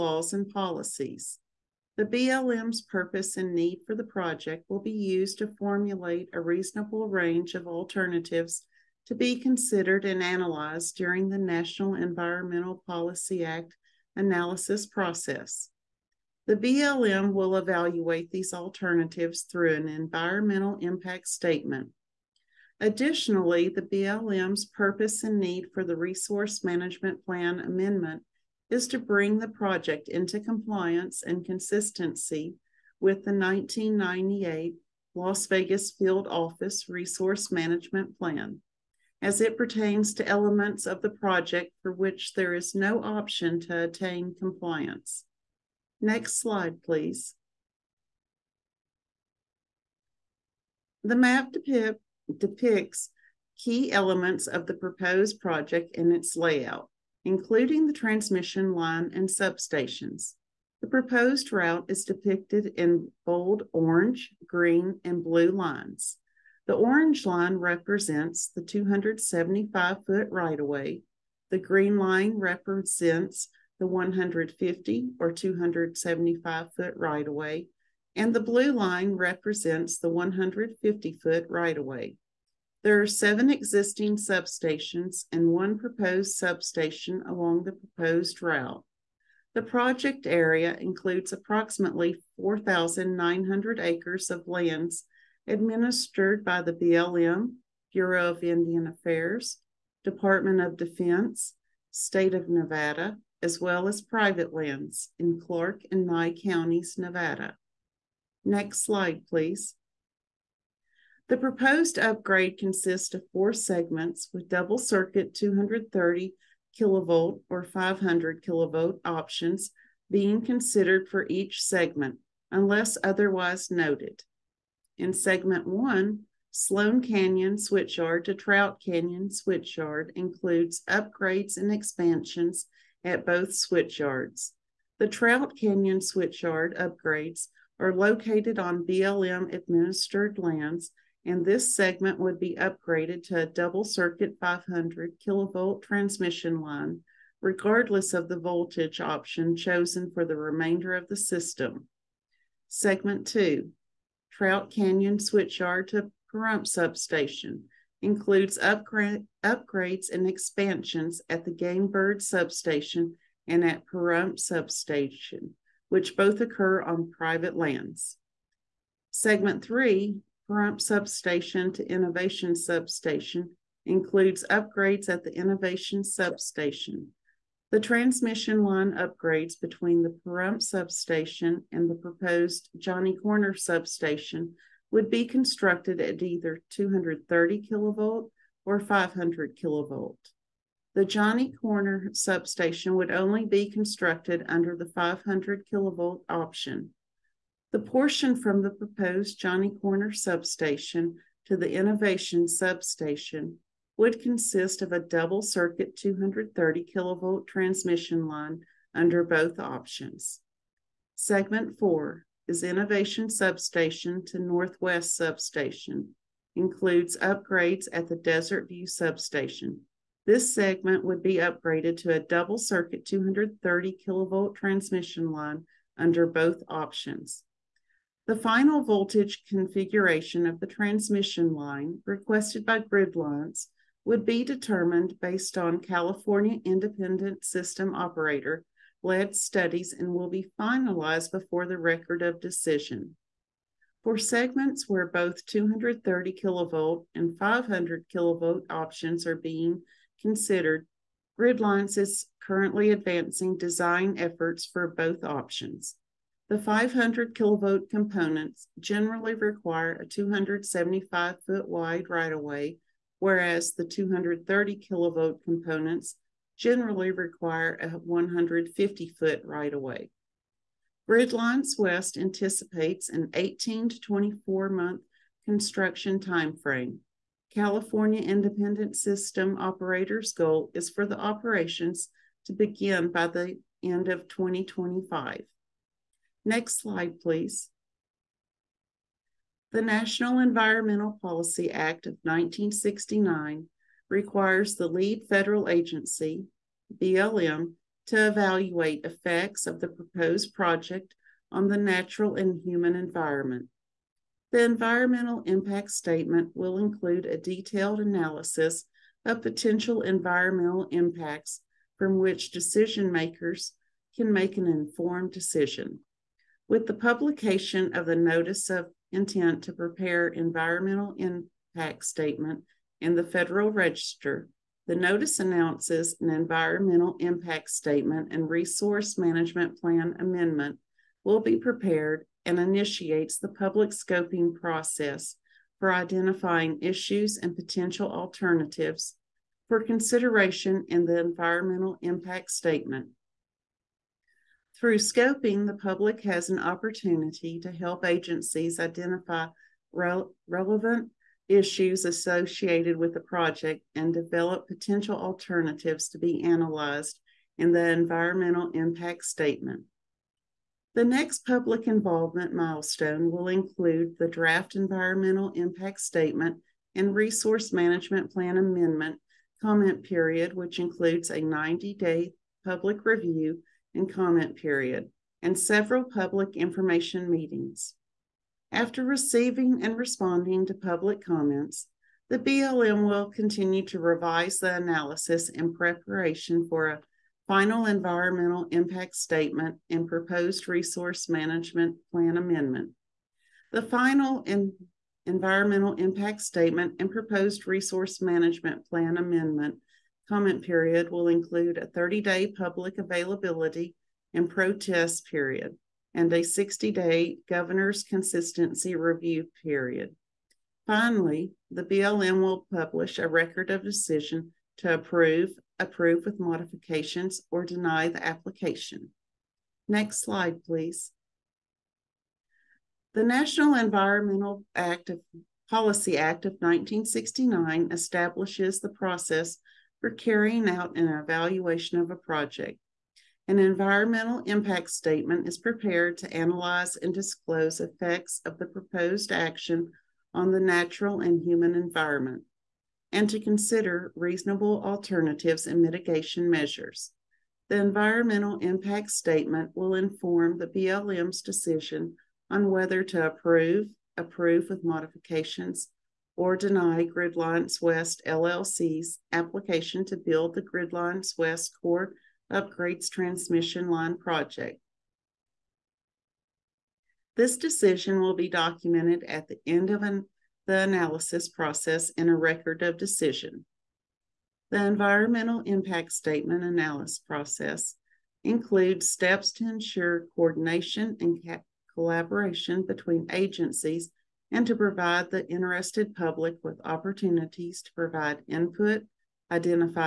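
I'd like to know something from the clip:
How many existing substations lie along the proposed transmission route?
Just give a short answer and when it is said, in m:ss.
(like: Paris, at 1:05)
Seven, at 1:23.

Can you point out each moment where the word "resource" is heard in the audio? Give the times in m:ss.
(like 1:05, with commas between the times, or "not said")
0:25, 0:36, 5:28, 6:07, 6:30, 6:37.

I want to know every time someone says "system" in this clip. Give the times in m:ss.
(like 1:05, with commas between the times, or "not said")
2:31, 3:57, 4:38.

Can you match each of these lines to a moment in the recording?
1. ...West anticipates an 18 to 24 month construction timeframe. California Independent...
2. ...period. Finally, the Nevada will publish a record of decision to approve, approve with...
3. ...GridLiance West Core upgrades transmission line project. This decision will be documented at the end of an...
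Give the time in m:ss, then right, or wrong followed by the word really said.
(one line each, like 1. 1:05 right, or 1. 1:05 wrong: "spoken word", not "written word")
1. 4:31 right
2. 6:49 wrong: "BLM", not "Nevada"
3. 7:40 right.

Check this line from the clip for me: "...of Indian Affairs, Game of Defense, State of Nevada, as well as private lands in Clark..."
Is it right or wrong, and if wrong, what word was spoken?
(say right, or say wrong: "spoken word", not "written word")
wrong: "Department", not "Game".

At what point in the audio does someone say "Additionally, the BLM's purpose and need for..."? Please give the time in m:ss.
0:22.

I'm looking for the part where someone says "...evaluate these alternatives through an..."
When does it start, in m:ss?
0:17.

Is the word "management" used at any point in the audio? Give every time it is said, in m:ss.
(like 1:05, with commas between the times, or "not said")
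0:26, 0:37, 5:29, 6:07, 6:31, 6:38.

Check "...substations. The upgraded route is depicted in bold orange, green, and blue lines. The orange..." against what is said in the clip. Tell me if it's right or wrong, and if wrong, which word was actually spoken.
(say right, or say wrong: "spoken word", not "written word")
wrong: "proposed", not "upgraded".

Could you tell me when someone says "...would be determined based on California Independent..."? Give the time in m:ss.
3:54.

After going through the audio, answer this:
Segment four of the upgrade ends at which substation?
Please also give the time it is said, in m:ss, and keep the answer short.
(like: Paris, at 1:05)
Northwest Substation, at 3:34.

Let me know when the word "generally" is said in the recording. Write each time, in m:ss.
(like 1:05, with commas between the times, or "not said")
4:18, 4:26.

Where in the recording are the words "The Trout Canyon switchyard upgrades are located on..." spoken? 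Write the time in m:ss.
2:14.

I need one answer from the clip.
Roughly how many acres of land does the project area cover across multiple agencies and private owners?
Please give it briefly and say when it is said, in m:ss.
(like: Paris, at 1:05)
4,900, at 1:32.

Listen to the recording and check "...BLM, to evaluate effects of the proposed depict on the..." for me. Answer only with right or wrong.
wrong.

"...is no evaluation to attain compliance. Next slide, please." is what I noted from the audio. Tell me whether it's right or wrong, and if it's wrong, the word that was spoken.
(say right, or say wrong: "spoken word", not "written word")
wrong: "option", not "evaluation".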